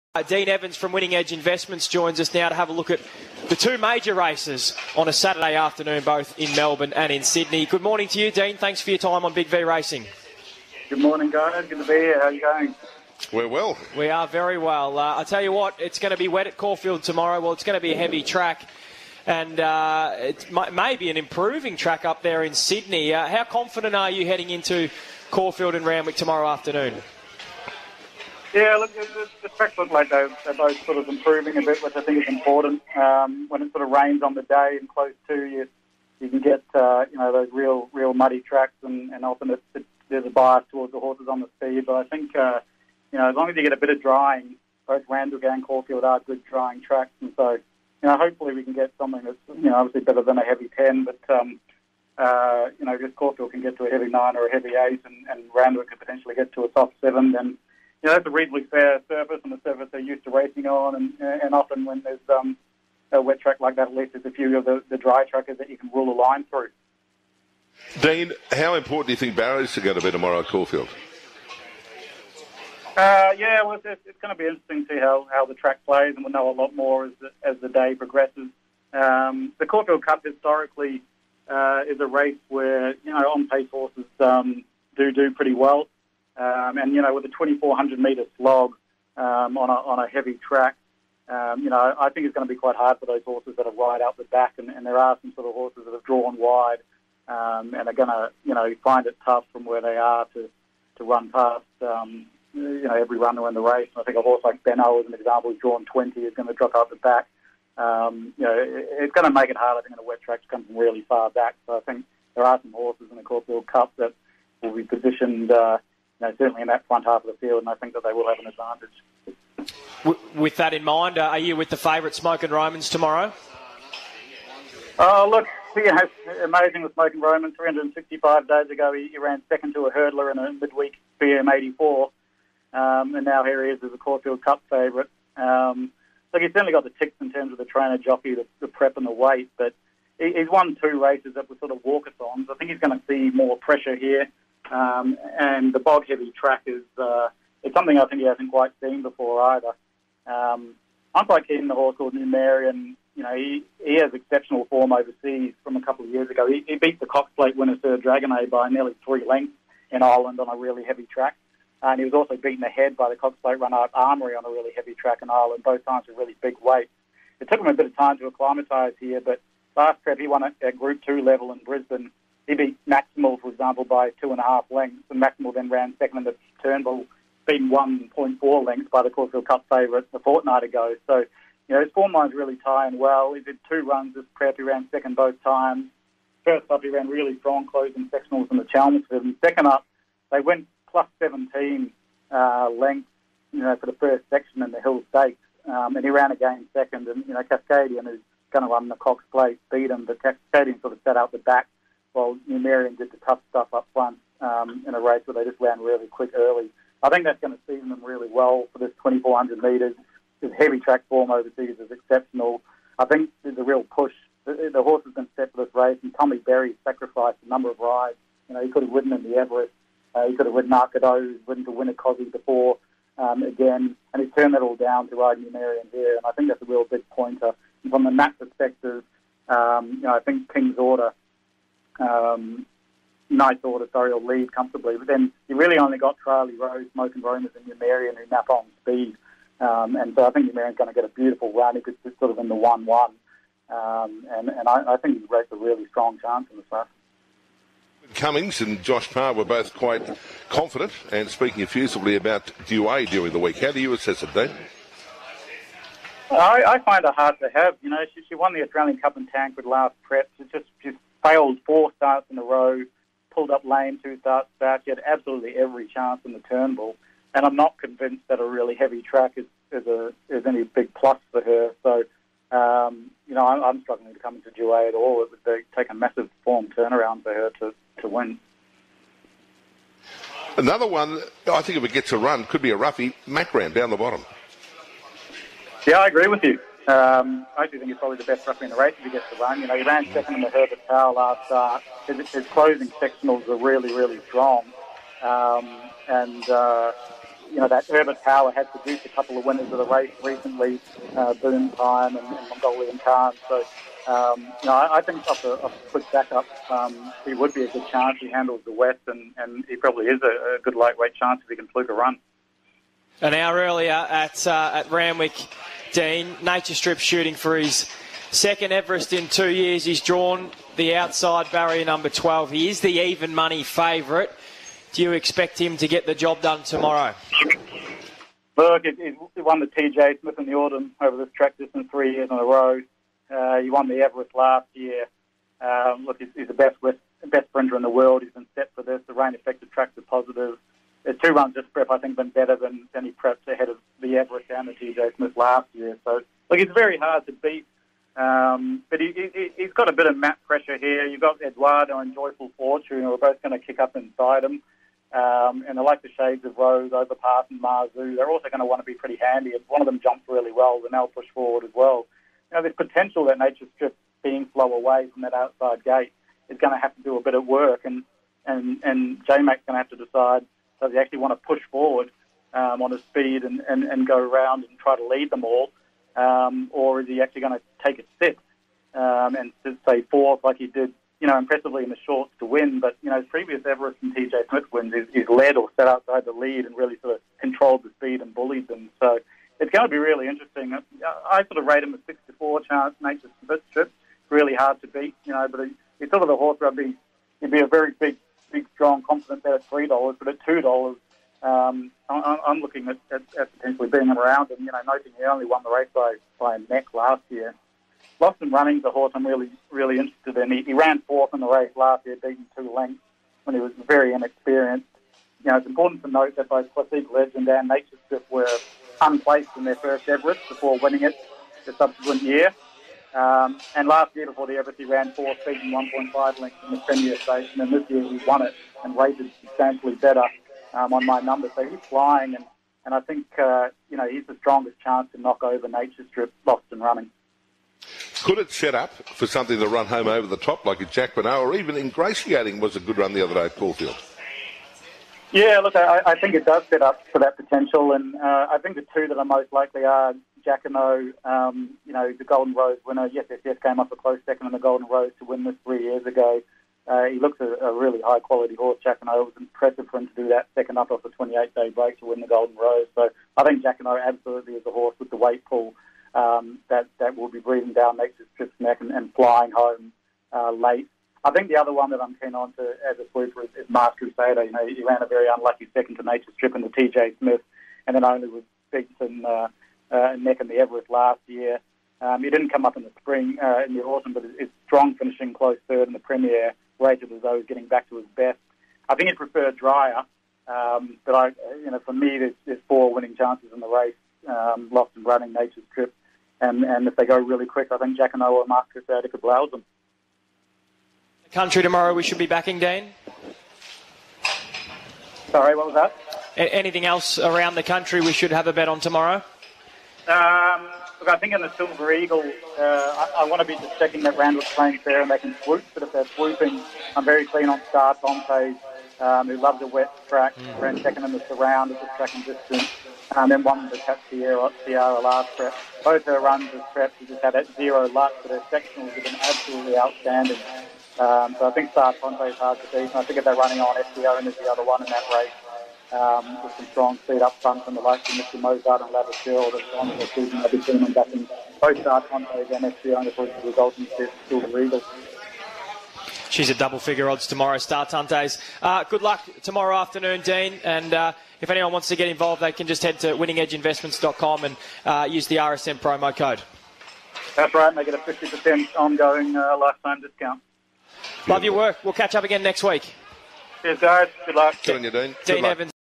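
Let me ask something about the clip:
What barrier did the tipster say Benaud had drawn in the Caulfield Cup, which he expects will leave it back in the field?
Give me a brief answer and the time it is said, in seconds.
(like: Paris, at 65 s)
20, at 105 s.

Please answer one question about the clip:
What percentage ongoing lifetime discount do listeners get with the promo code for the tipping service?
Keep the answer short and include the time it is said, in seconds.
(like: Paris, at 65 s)
50%, at 557 s.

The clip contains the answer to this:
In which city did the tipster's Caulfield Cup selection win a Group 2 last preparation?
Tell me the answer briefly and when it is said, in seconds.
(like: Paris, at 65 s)
Brisbane, at 171 s.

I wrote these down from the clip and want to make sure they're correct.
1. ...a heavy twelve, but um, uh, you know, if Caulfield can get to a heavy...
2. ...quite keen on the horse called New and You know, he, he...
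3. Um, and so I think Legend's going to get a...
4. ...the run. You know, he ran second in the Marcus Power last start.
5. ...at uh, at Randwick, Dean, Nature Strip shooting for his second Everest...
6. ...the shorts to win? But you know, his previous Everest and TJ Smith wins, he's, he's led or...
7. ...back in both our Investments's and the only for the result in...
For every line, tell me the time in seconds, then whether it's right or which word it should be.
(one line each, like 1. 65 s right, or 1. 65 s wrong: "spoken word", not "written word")
1. 50 s wrong: "ten", not "twelve"
2. 151 s right
3. 239 s wrong: "Numerian", not "Legend"
4. 289 s wrong: "Herbert", not "Marcus"
5. 313 s right
6. 381 s right
7. 540 s wrong: "Conte", not "Investments".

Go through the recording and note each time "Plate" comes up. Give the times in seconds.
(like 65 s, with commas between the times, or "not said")
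157 s, 163 s, 199 s.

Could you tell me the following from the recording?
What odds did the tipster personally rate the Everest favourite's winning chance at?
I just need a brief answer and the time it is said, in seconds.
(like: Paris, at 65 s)
6 to 4, at 392 s.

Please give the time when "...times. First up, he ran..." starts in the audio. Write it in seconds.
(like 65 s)
185 s.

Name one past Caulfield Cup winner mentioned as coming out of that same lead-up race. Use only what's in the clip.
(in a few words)
Boom Time.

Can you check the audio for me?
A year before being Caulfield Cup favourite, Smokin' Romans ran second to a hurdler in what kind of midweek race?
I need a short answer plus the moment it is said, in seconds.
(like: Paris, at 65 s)
BM84, at 131 s.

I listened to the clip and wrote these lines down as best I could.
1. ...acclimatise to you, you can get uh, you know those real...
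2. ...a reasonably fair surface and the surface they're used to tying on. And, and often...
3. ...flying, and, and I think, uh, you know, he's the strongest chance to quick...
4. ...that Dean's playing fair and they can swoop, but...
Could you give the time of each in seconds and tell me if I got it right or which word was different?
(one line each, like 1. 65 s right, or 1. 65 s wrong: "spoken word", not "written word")
1. 34 s wrong: "close", not "acclimatise"
2. 58 s wrong: "racing", not "tying"
3. 431 s wrong: "knock", not "quick"
4. 514 s wrong: "Randall", not "Dean".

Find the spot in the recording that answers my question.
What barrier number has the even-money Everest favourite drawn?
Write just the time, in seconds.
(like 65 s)
322 s.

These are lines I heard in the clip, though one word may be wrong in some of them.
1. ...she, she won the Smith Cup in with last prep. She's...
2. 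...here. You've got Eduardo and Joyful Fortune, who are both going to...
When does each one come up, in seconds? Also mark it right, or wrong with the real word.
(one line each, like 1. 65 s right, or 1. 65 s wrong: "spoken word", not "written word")
1. 258 s wrong: "Australian", not "Smith"
2. 350 s right.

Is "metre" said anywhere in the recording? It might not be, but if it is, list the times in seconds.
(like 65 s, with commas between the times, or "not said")
87 s, 209 s.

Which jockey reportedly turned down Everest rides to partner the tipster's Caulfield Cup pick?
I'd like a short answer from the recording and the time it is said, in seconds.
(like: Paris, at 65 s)
Tommy Berry, at 216 s.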